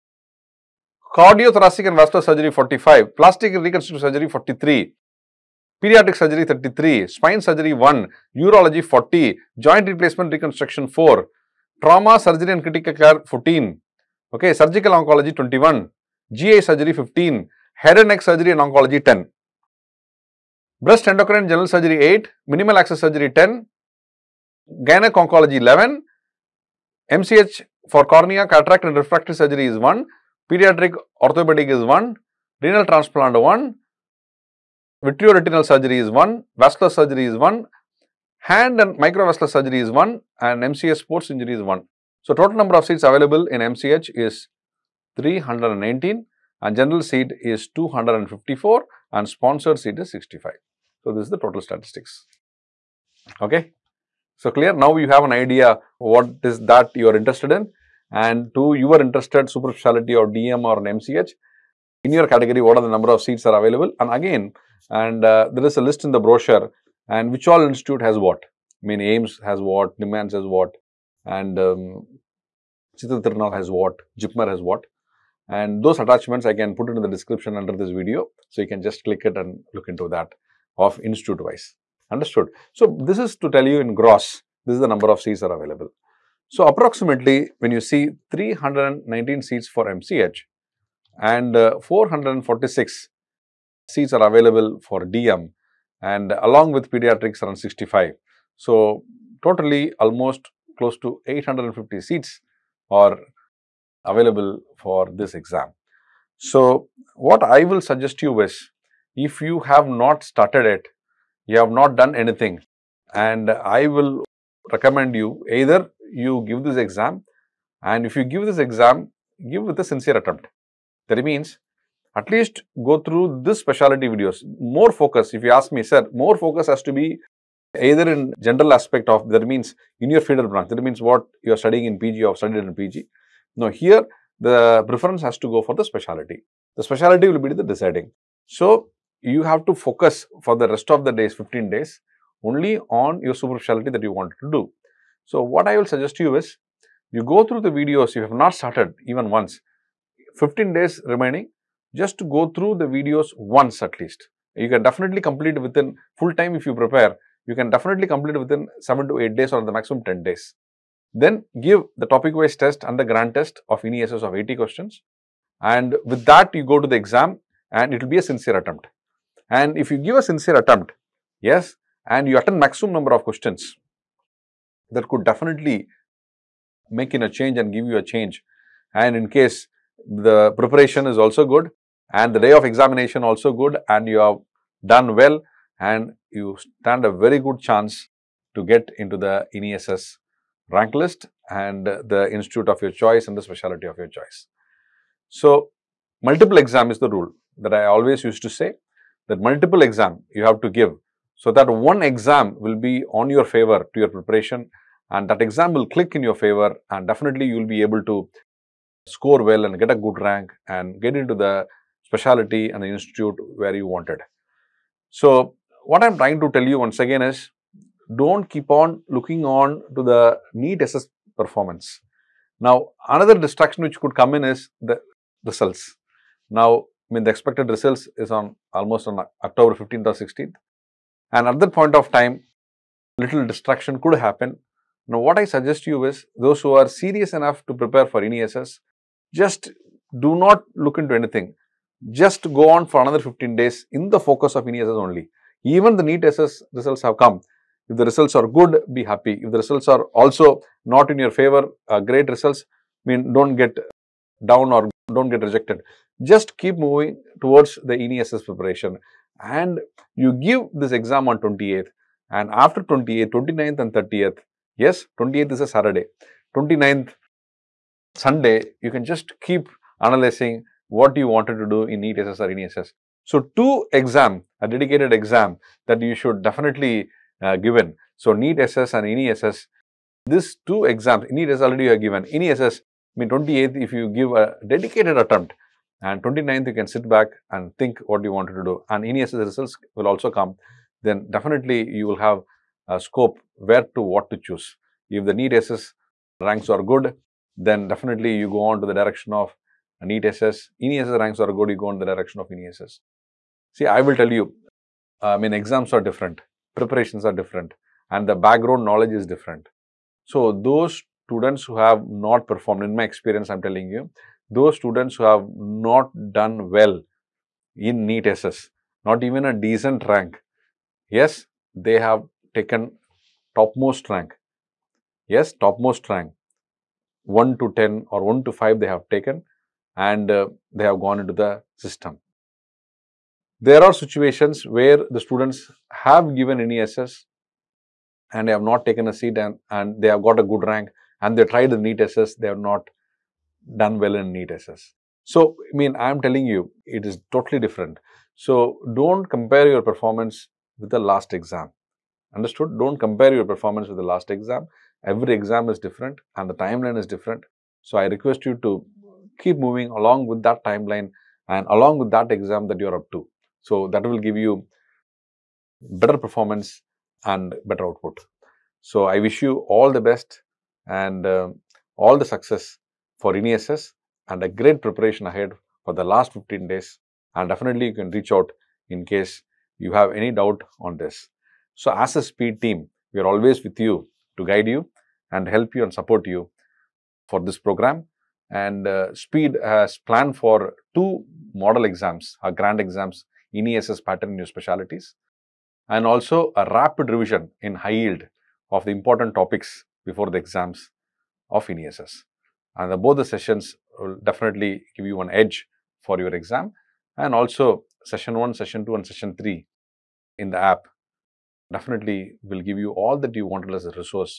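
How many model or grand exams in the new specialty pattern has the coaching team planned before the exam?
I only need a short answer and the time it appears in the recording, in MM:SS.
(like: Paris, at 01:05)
2, at 06:30.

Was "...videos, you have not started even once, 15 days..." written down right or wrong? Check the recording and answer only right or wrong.
right.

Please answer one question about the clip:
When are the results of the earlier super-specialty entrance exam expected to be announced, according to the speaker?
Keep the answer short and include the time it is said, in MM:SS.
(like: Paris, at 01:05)
October 15th or 16th, at 03:49.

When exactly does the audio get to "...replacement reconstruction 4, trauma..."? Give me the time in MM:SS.
00:09.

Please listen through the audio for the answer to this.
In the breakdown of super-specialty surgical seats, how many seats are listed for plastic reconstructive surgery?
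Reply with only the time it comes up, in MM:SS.
00:03.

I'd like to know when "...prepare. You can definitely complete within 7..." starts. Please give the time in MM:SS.
02:36.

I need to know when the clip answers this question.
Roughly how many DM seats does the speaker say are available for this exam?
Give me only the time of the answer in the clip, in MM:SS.
01:31.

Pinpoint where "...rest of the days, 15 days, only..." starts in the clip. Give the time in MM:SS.
02:20.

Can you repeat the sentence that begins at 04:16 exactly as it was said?
Just keep moving towards the NESS preparation.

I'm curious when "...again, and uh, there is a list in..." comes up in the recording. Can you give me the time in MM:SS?
01:04.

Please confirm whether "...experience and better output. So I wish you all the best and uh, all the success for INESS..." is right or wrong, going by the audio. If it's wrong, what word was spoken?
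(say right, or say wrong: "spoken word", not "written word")
wrong: "performance", not "experience".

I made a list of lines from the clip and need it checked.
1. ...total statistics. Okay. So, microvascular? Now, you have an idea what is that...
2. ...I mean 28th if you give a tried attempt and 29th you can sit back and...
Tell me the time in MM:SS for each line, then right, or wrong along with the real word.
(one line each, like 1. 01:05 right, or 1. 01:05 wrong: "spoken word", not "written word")
1. 00:51 wrong: "clear", not "microvascular"
2. 04:43 wrong: "dedicated", not "tried".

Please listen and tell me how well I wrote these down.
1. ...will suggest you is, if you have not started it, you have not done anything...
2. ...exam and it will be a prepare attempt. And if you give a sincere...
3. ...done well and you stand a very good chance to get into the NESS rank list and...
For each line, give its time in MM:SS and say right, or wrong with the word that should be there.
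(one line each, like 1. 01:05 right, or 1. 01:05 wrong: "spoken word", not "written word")
1. 01:47 right
2. 02:46 wrong: "sincere", not "prepare"
3. 03:04 right.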